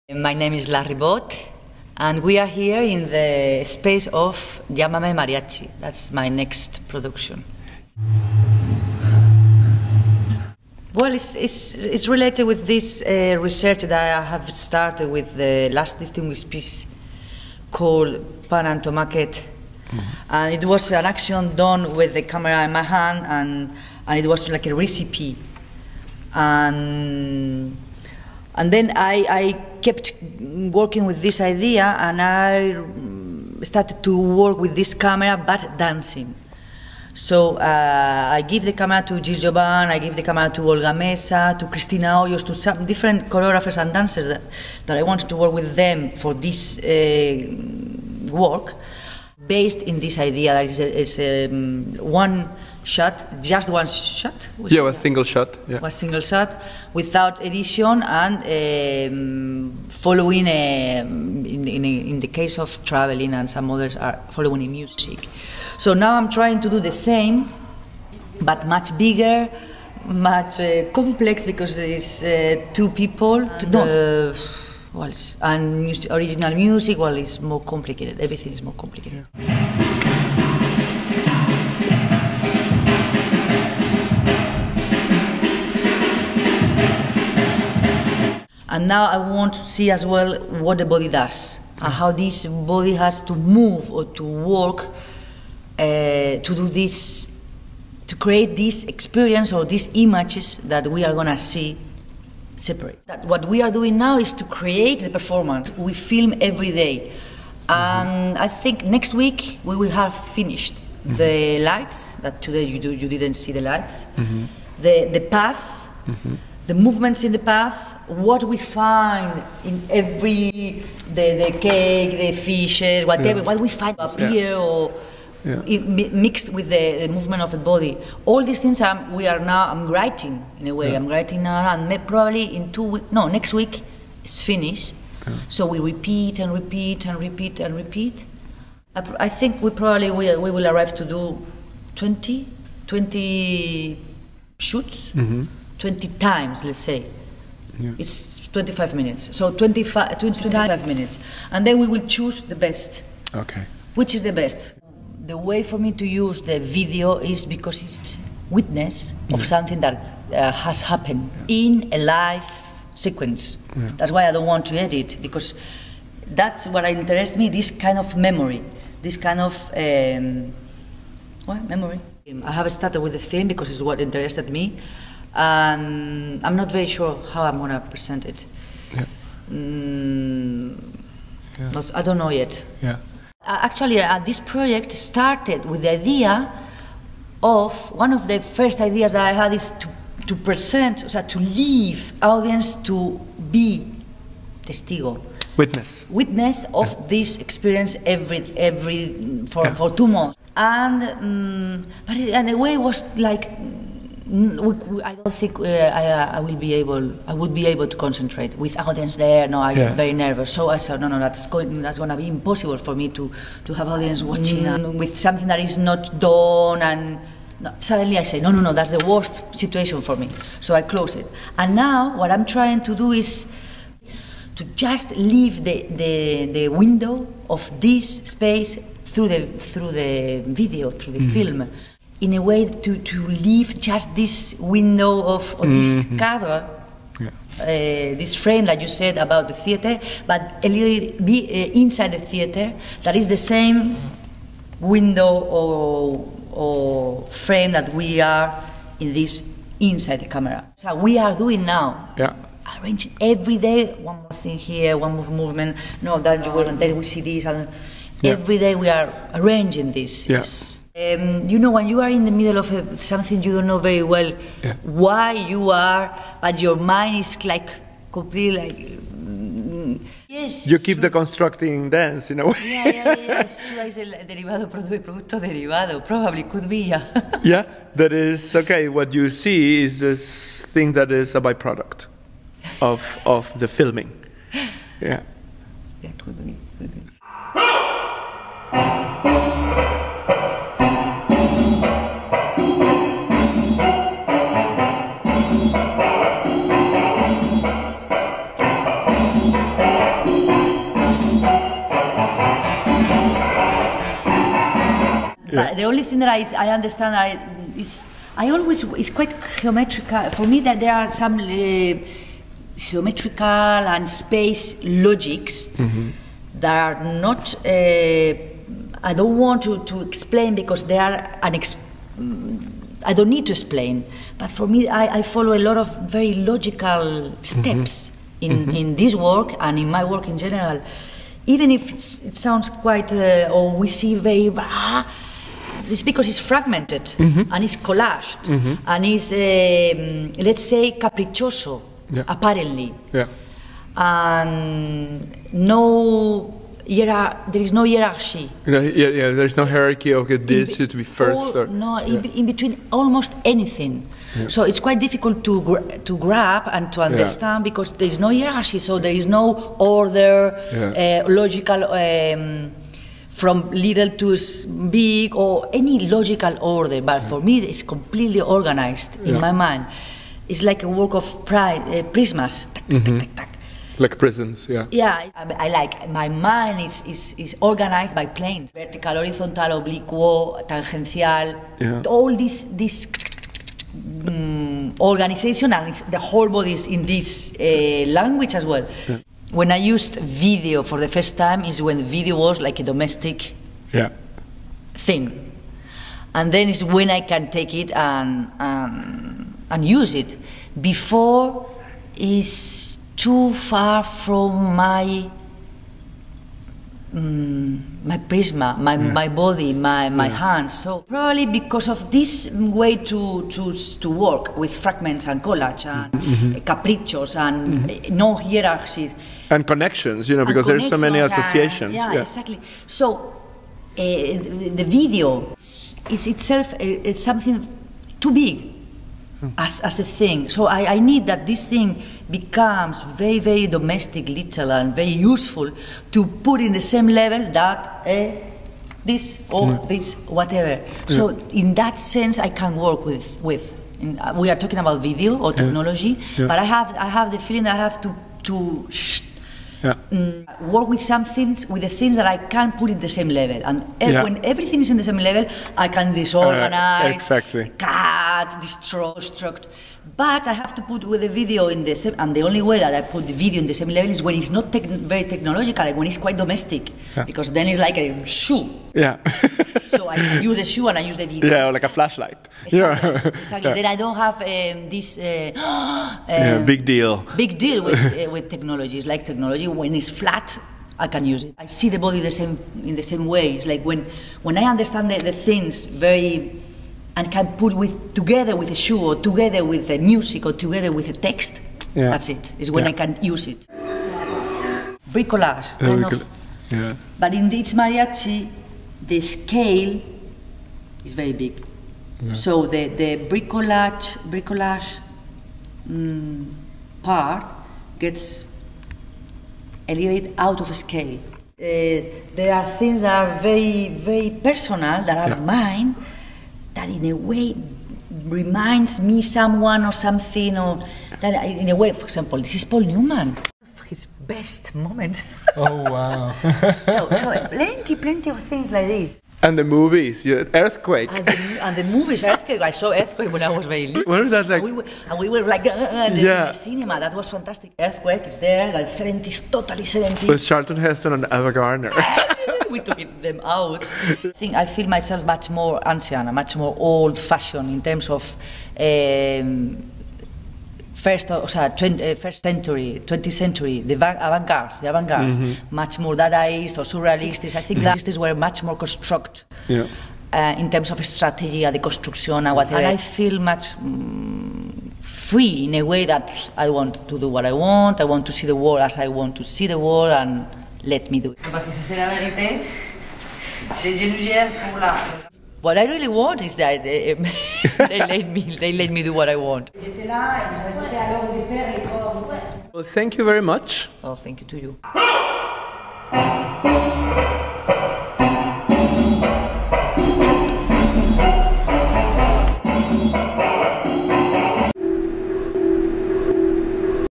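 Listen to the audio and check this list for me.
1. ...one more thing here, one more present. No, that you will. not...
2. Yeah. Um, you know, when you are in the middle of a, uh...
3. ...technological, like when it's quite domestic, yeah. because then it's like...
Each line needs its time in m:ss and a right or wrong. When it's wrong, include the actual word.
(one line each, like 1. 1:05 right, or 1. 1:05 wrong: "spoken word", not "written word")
1. 4:13 wrong: "movement", not "present"
2. 4:20 right
3. 7:45 right.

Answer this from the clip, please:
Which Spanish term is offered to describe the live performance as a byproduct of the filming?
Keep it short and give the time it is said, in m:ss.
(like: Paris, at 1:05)
producto derivado, at 4:34.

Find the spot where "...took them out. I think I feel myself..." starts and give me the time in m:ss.
9:02.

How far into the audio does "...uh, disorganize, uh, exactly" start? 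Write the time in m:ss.
7:36.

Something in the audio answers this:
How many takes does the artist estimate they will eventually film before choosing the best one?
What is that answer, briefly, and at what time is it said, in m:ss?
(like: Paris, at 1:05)
20, at 2:25.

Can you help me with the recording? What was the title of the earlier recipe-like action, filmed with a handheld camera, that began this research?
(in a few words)
Pa amb tomàquet.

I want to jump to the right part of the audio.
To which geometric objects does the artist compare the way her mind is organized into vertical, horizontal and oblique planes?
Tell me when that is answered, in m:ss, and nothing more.
6:12.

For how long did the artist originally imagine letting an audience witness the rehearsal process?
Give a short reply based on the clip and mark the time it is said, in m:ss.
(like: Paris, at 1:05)
two months, at 3:19.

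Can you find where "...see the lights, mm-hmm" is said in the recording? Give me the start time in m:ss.
1:53.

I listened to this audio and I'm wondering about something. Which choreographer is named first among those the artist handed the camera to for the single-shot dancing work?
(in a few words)
Gilles Jobin.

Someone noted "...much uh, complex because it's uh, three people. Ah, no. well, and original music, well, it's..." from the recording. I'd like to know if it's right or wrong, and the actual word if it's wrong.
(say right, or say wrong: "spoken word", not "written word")
wrong: "two", not "three".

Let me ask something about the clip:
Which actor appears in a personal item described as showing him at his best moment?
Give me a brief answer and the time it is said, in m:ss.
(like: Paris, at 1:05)
Paul Newman, at 8:42.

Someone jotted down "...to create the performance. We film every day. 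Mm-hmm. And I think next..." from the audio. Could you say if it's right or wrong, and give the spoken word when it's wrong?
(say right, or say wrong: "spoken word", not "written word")
right.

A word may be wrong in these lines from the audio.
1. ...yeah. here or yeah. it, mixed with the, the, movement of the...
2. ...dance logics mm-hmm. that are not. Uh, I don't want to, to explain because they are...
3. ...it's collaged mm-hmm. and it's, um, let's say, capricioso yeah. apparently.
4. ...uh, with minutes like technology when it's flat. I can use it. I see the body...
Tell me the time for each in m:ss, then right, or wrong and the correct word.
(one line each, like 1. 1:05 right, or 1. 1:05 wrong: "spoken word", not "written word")
1. 2:04 right
2. 5:14 wrong: "space", not "dance"
3. 5:37 right
4. 7:58 wrong: "technologies", not "minutes".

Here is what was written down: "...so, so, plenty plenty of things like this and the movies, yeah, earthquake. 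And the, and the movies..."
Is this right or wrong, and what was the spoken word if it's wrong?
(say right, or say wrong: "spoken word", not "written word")
right.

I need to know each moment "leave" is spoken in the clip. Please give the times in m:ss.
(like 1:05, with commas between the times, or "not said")
3:11, 3:45, 3:53.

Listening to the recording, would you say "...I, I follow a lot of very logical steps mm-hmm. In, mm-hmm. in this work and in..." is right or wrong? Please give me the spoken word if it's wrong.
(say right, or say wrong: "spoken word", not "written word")
right.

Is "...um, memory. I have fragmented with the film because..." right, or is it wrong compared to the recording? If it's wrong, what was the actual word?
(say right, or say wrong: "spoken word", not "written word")
wrong: "started", not "fragmented".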